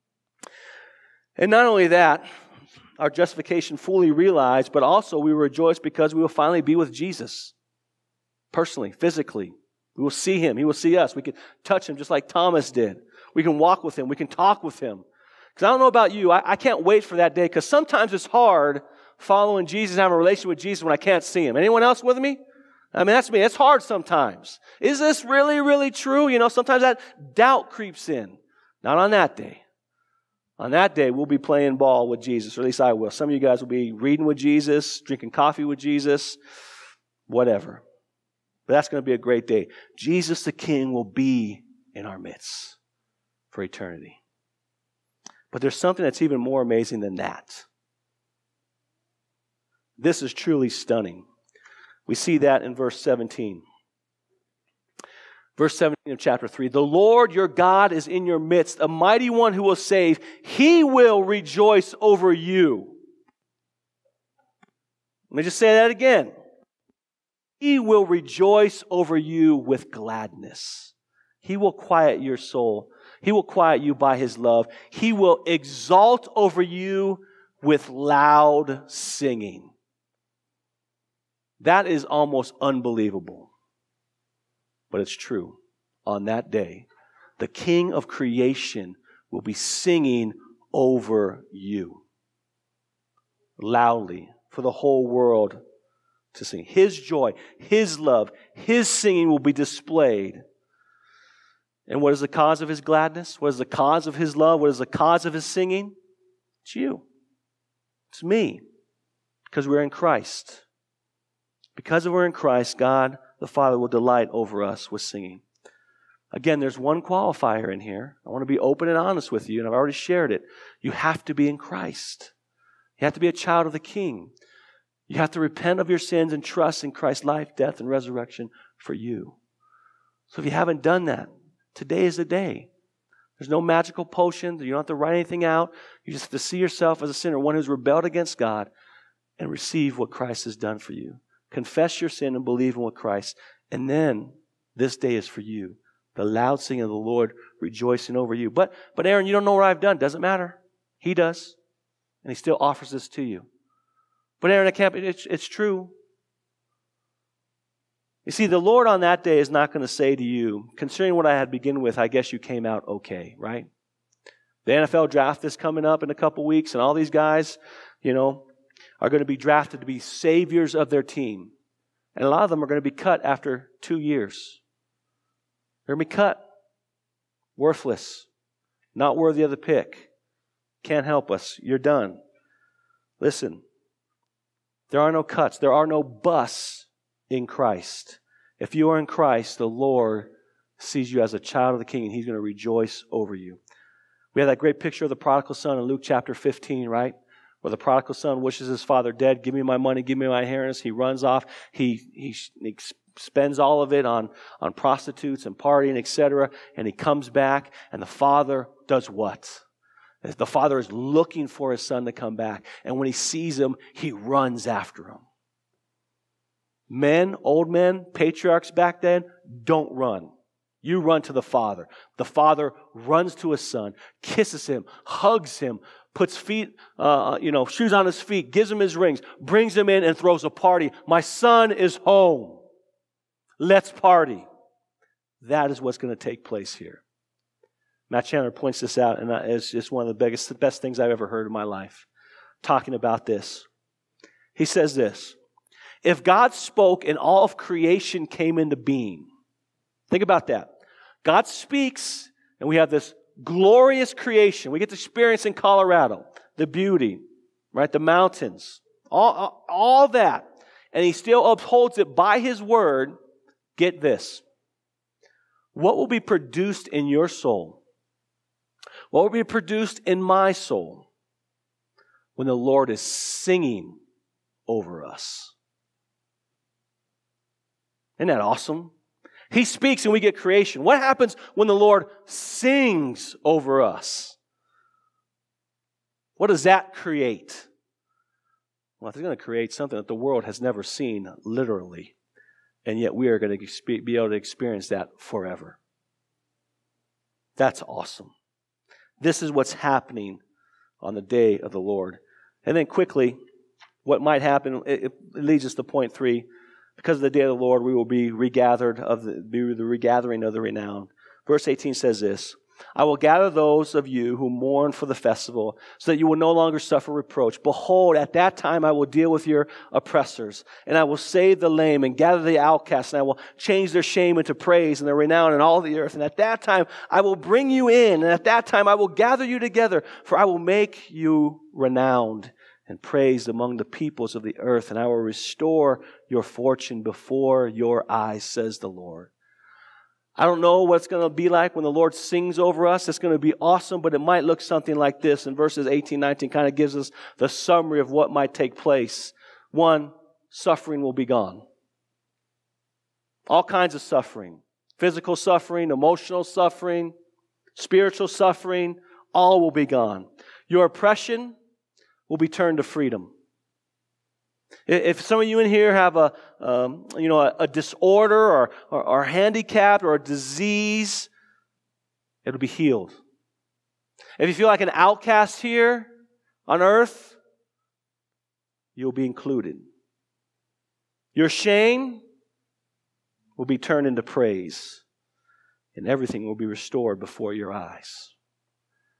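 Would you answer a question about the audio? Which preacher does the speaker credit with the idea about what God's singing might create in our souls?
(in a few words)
Matt Chandler.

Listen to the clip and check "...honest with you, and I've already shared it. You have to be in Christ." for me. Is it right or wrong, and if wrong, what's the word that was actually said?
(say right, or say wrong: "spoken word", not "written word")
right.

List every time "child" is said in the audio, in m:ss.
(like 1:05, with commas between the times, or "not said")
2:03, 3:11.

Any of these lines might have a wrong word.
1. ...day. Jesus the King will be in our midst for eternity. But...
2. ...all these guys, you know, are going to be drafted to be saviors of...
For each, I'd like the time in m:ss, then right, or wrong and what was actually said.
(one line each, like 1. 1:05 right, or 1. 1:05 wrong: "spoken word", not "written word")
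1. 0:39 right
2. 2:46 right.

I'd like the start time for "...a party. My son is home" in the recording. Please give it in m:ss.
3:50.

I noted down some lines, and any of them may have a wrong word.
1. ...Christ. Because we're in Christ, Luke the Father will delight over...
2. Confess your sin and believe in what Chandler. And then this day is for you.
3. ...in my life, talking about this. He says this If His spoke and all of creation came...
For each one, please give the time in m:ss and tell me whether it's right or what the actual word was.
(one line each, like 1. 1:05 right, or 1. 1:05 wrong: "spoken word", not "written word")
1. 1:49 wrong: "God", not "Luke"
2. 2:21 wrong: "Christ", not "Chandler"
3. 4:01 wrong: "God", not "His".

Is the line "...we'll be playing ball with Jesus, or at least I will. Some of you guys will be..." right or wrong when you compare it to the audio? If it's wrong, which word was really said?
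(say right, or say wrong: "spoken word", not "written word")
right.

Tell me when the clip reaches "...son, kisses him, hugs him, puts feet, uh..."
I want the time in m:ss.
3:43.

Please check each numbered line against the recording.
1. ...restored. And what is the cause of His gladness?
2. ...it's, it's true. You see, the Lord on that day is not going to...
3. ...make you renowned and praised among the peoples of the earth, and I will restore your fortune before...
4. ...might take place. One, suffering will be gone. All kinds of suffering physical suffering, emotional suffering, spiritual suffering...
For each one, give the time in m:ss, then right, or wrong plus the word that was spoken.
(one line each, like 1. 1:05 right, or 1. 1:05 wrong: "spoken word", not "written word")
1. 1:39 wrong: "displayed", not "restored"
2. 2:34 right
3. 5:30 right
4. 5:48 right.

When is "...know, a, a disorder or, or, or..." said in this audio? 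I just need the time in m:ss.
6:07.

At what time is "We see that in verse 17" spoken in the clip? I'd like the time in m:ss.
0:52.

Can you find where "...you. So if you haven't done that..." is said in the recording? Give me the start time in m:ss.
2:08.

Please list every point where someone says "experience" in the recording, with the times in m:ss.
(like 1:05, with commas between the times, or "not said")
4:14, 4:54.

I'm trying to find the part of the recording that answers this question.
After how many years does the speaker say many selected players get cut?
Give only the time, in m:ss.
2:53.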